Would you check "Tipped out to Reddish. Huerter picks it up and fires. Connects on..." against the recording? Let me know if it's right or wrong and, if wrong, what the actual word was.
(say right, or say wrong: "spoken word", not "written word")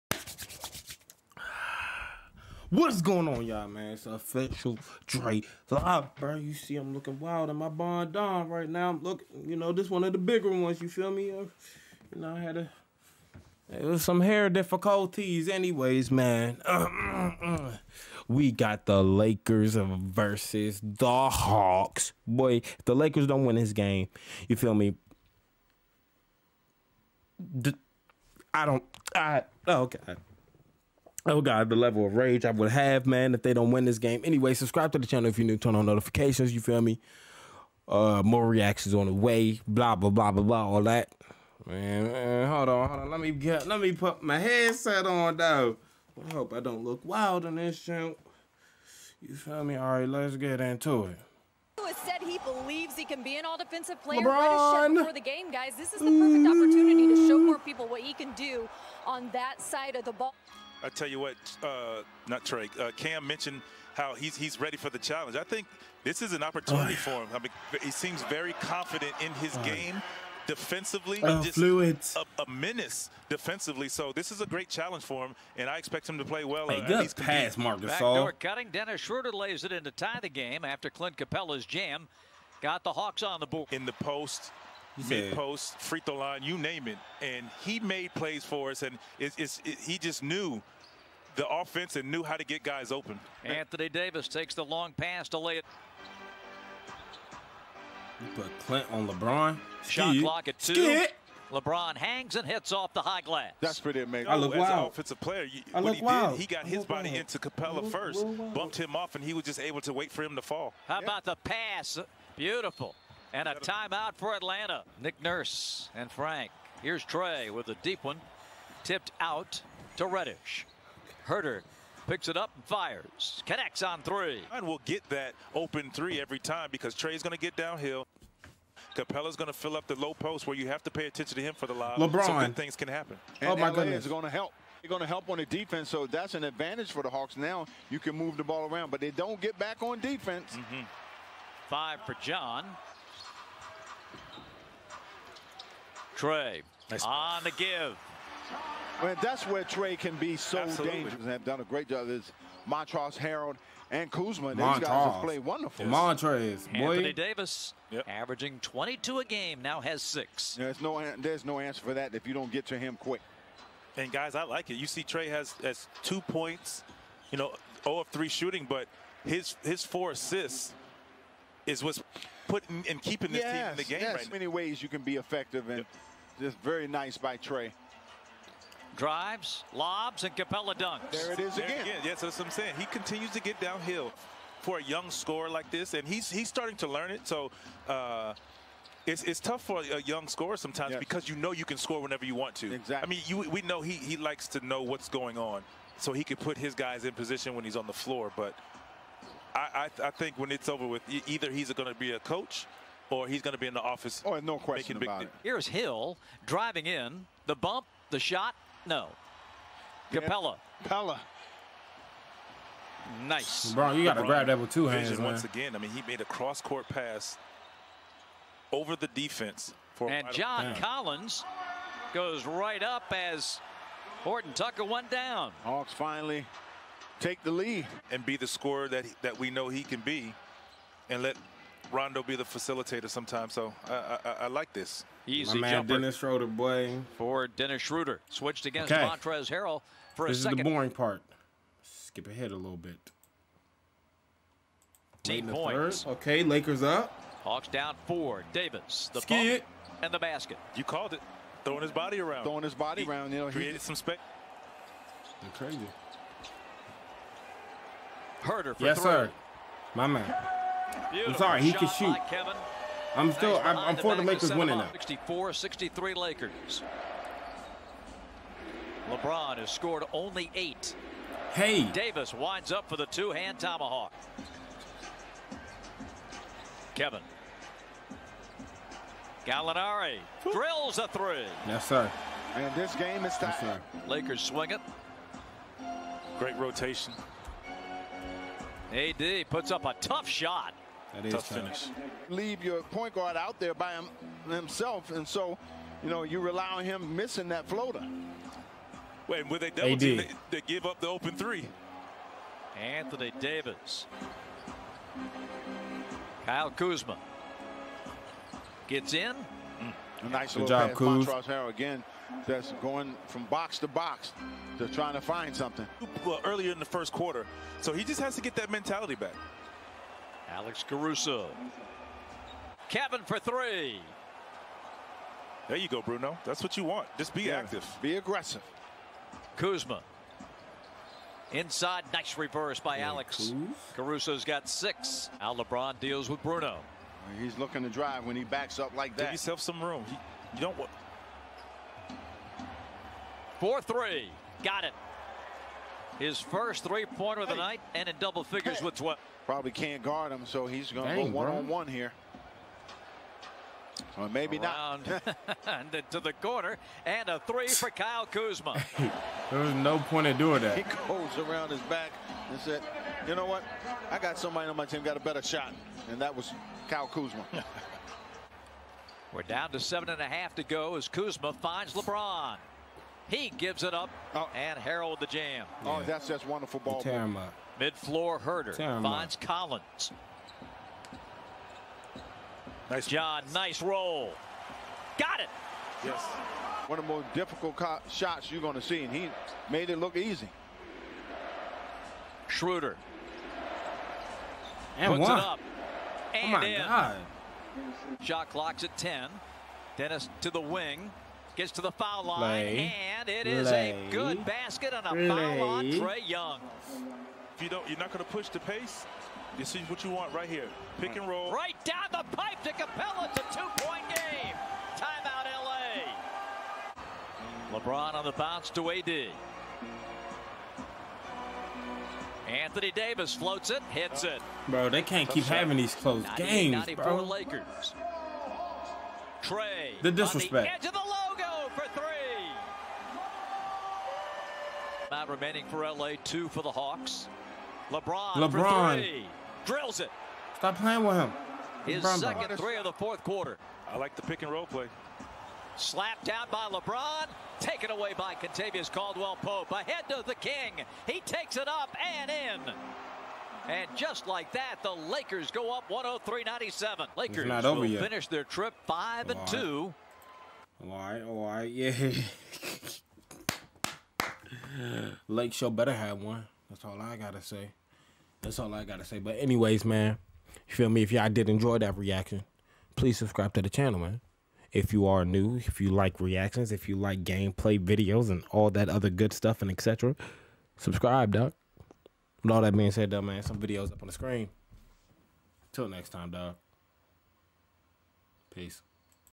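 right.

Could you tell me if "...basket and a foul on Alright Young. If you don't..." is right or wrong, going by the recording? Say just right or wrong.
wrong.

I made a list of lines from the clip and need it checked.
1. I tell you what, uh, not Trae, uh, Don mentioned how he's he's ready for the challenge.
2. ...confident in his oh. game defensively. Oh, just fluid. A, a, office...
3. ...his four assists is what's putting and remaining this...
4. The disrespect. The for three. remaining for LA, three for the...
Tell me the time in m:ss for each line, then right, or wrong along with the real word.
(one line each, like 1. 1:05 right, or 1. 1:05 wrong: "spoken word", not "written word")
1. 1:00 wrong: "Cam", not "Don"
2. 1:08 wrong: "menace", not "office"
3. 2:49 wrong: "keeping", not "remaining"
4. 7:10 wrong: "two", not "three".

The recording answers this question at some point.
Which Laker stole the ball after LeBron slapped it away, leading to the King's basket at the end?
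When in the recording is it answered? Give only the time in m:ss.
7:28.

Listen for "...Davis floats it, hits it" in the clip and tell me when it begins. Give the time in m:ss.
7:02.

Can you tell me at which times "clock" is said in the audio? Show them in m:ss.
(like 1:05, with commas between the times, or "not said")
1:40, 6:38.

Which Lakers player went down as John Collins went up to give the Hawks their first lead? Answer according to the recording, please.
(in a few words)
Horton Tucker.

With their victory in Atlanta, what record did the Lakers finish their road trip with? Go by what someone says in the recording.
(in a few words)
5 and 2.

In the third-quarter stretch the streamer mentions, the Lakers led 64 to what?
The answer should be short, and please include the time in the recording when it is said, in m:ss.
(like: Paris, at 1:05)
63, at 4:25.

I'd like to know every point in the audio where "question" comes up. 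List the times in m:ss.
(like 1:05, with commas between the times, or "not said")
3:24.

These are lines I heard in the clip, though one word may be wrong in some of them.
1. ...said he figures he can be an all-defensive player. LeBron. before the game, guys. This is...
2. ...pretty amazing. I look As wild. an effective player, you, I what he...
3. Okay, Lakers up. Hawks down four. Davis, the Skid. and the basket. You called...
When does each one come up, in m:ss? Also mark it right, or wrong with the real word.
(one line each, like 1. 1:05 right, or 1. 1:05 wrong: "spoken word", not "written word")
1. 0:52 wrong: "believes", not "figures"
2. 1:43 wrong: "offensive", not "effective"
3. 4:06 right.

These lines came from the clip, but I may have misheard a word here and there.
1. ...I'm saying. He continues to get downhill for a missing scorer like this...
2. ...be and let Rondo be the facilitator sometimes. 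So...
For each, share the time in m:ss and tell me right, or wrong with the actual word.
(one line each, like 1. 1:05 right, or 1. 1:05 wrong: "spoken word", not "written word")
1. 3:02 wrong: "young", not "missing"
2. 3:50 right.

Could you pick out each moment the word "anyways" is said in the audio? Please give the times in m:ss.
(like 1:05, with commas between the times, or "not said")
0:15, 0:34, 7:49.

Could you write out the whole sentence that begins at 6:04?
I got somebody on my team got a better shot, and that was Kyle Kuzma.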